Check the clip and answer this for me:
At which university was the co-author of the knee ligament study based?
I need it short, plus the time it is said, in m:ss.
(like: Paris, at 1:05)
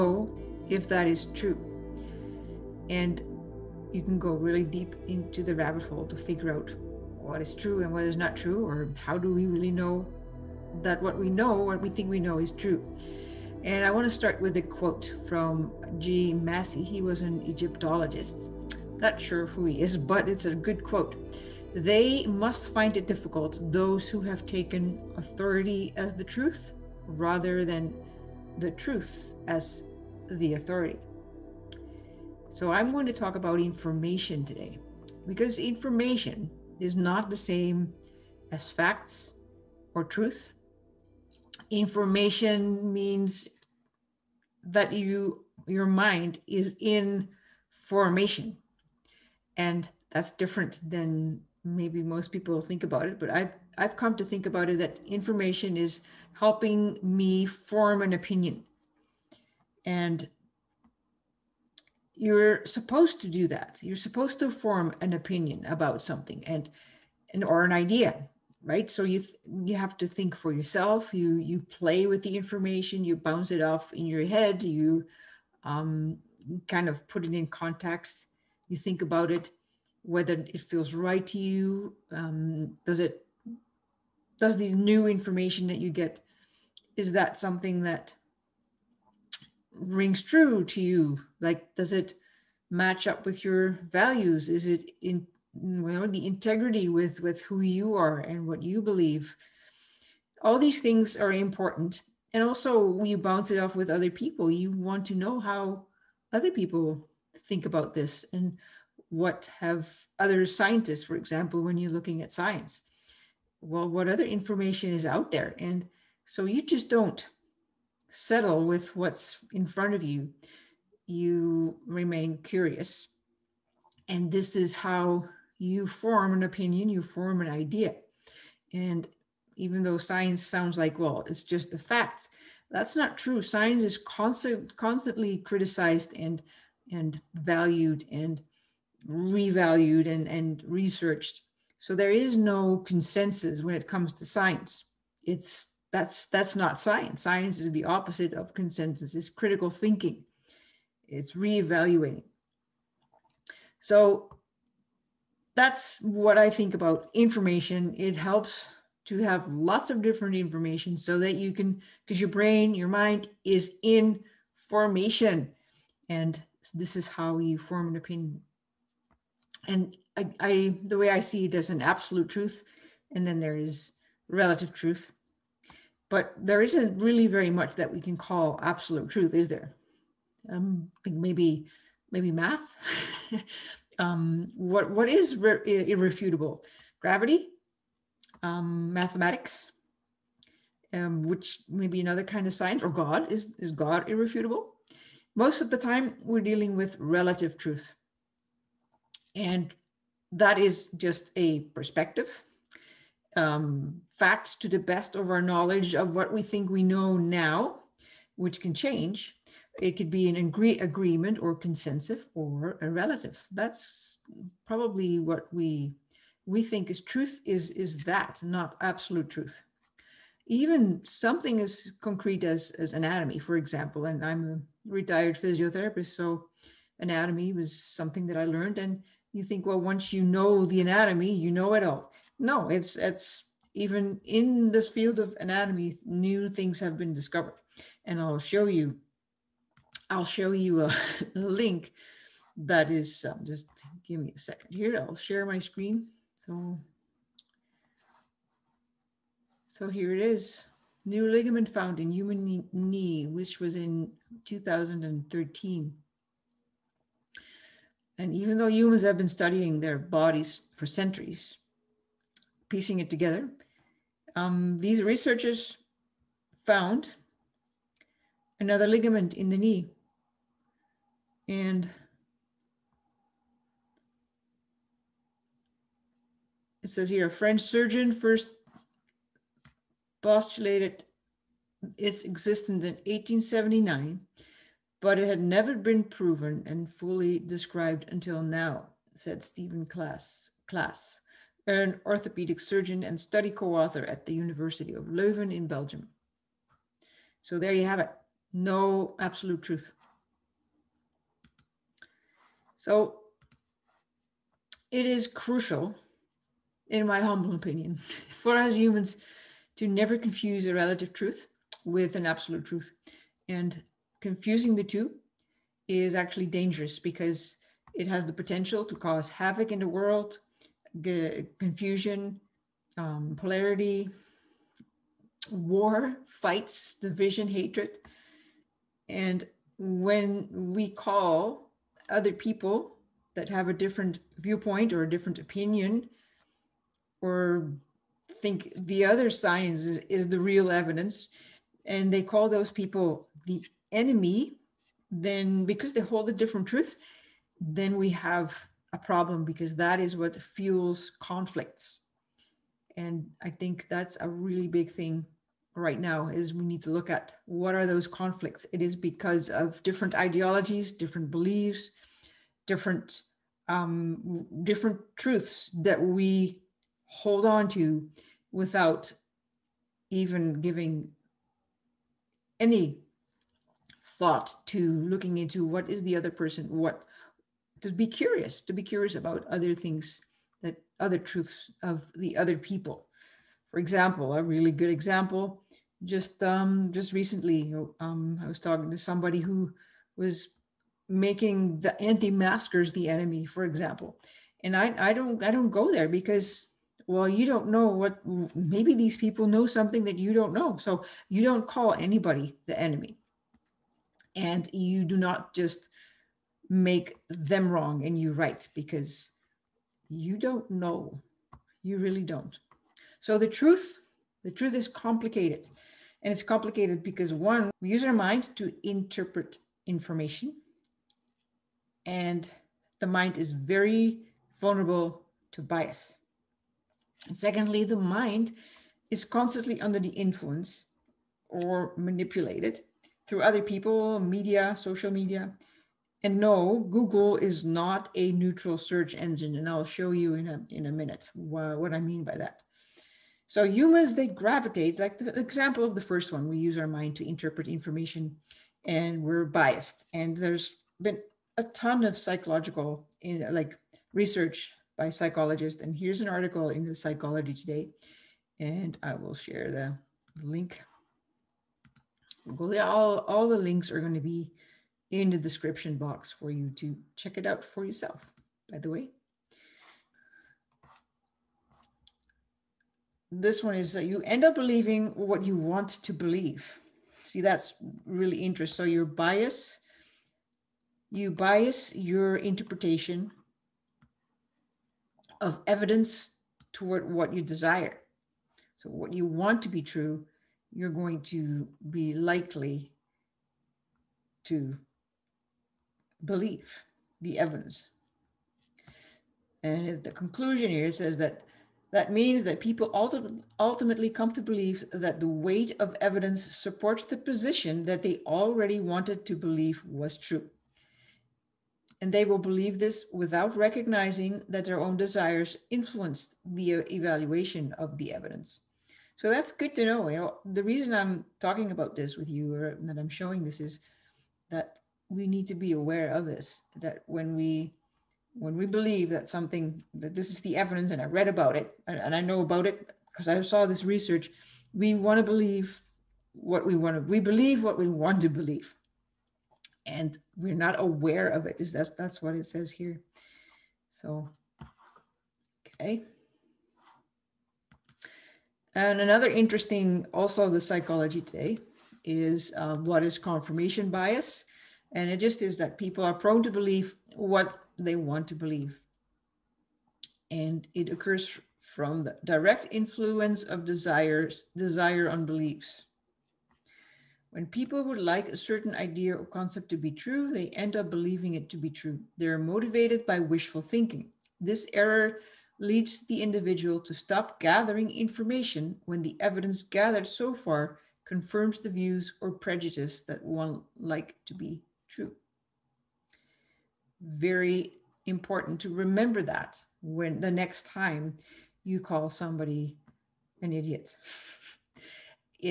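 University of Leuven, at 4:54.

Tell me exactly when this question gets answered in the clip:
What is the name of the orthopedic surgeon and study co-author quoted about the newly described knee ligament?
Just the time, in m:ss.
4:49.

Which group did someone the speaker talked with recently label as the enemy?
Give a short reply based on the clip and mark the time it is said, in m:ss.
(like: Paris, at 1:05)
Anti-maskers, at 6:32.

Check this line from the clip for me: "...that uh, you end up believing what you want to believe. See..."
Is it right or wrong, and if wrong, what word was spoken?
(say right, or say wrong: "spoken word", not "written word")
right.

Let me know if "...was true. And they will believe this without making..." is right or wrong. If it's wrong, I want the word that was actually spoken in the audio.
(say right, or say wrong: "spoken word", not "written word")
wrong: "recognizing", not "making".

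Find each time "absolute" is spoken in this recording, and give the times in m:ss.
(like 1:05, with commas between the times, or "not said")
2:51, 2:58, 3:38, 4:59, 5:12.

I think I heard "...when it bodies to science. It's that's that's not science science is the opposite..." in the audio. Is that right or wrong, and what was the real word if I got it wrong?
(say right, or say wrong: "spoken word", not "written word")
wrong: "comes", not "bodies".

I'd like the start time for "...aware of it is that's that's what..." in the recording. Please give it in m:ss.
9:00.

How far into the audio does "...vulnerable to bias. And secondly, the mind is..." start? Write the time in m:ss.
7:04.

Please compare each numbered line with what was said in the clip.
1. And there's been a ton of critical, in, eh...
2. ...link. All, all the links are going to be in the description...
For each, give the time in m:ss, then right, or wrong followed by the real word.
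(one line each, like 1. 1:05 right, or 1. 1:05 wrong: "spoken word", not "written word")
1. 7:30 wrong: "psychological", not "critical"
2. 7:40 right.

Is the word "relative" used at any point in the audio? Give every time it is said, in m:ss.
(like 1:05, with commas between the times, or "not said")
2:54, 3:16, 3:32, 5:10.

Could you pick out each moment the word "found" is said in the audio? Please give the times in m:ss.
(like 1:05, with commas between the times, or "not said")
4:11, 4:26.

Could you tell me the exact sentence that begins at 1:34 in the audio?
Is it in you know, the integrity with with who you are and what you believe?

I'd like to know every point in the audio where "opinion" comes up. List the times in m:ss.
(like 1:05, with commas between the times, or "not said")
0:58, 1:05, 2:06, 2:47, 5:07, 5:35.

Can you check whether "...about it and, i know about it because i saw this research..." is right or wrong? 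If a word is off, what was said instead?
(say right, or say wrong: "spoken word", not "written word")
right.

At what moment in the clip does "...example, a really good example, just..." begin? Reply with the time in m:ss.
6:23.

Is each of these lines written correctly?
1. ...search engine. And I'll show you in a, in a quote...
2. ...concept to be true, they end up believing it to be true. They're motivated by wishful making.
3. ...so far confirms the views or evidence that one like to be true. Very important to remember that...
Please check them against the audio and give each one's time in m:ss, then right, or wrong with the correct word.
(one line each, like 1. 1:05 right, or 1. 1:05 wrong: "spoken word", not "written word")
1. 7:18 wrong: "minute", not "quote"
2. 9:29 wrong: "thinking", not "making"
3. 9:40 wrong: "prejudice", not "evidence".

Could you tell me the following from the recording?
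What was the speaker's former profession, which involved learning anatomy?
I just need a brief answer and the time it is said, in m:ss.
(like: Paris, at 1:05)
Physiotherapist, at 3:45.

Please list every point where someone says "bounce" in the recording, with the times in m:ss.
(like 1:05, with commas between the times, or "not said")
1:13, 1:43.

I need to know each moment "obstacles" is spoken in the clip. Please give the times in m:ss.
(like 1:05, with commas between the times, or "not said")
not said.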